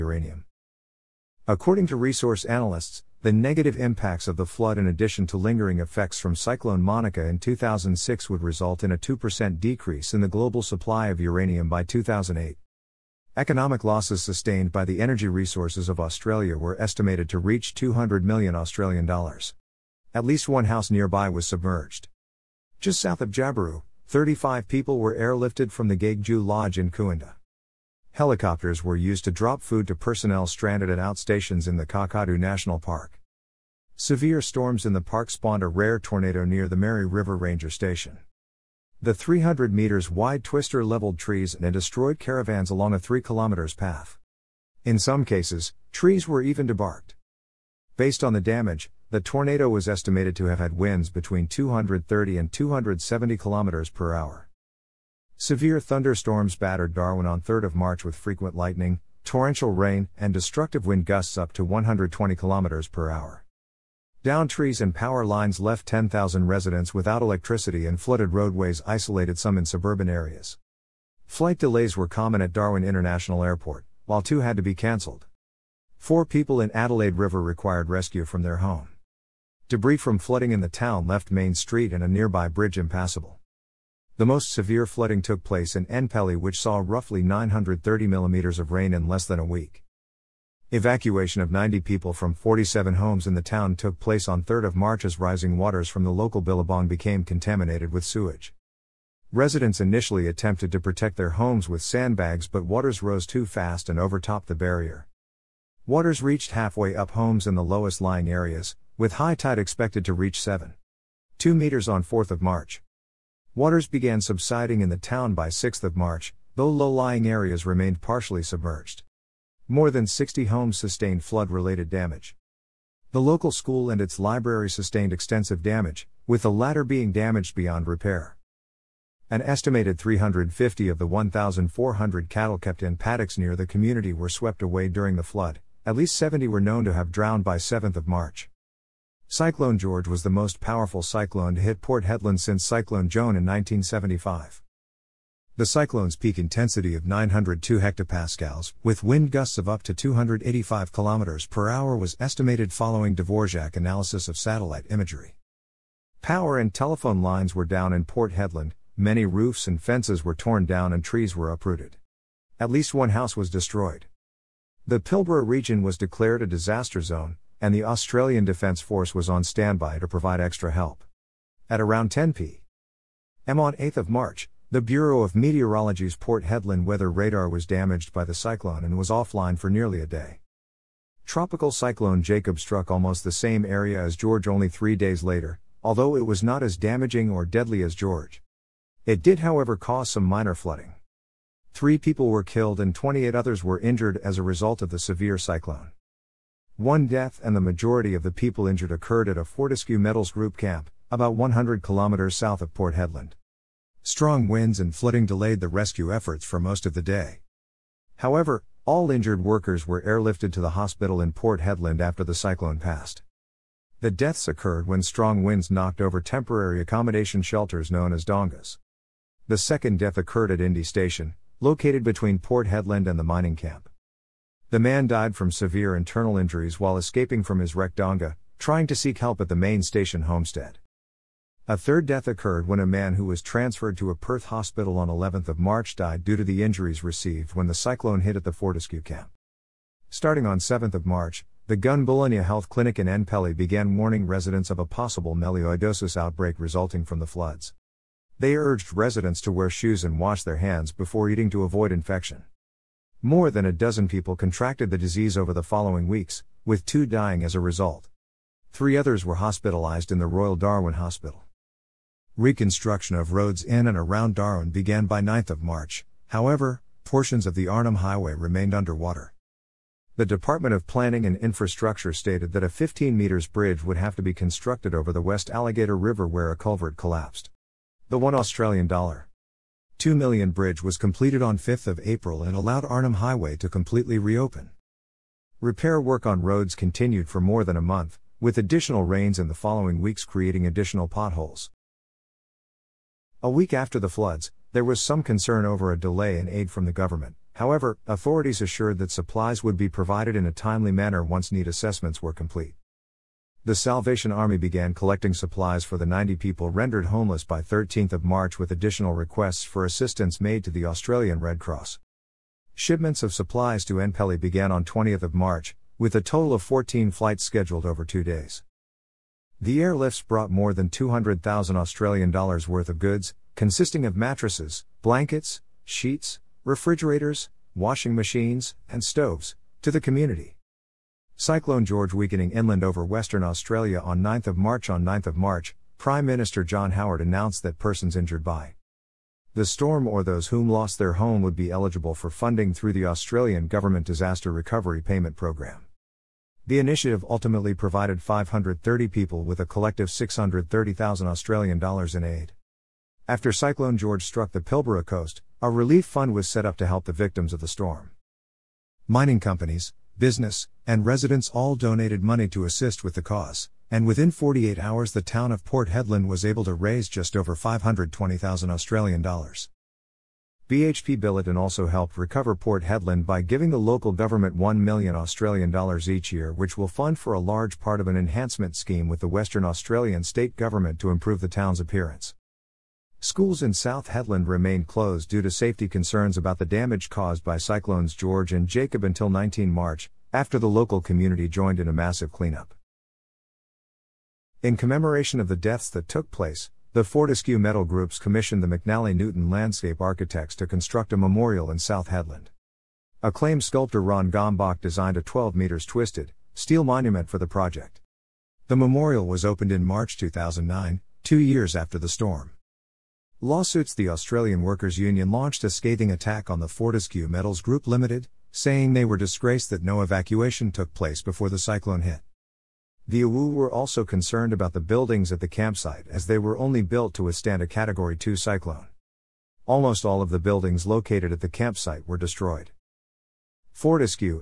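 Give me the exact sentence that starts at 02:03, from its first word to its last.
The local school and its library sustained extensive damage, with the latter being damaged beyond repair.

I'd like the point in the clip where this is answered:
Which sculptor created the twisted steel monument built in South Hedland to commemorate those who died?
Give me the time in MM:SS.
06:44.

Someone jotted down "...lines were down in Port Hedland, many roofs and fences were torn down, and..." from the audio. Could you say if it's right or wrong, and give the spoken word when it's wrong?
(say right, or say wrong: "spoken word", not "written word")
right.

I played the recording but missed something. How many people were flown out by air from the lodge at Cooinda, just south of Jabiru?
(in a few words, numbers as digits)
35.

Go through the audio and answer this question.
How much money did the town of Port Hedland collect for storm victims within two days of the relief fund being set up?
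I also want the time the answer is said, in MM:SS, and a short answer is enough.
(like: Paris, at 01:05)
Just over A$520,000, at 06:07.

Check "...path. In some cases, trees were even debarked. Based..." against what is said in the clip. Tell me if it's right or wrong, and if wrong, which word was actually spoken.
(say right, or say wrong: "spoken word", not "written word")
right.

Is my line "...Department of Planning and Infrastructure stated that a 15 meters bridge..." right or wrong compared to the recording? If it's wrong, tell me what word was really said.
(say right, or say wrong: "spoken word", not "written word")
right.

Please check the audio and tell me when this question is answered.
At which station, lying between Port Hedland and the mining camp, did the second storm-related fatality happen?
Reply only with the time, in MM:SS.
03:40.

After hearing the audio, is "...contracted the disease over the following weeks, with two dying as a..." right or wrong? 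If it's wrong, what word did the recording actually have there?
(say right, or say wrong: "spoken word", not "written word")
right.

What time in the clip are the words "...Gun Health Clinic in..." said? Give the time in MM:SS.
04:01.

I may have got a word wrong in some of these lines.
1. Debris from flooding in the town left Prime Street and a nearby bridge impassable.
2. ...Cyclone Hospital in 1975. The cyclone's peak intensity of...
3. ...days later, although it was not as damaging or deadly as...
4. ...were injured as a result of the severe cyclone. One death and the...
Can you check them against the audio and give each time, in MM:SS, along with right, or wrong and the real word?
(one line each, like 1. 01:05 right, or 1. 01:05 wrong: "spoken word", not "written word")
1. 01:19 wrong: "Main", not "Prime"
2. 02:22 wrong: "Joan", not "Hospital"
3. 03:04 right
4. 03:13 right.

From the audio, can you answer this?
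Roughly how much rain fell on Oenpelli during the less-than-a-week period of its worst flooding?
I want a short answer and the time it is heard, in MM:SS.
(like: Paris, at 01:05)
930 millimeters, at 01:27.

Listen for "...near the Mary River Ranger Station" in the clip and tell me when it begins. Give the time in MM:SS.
00:36.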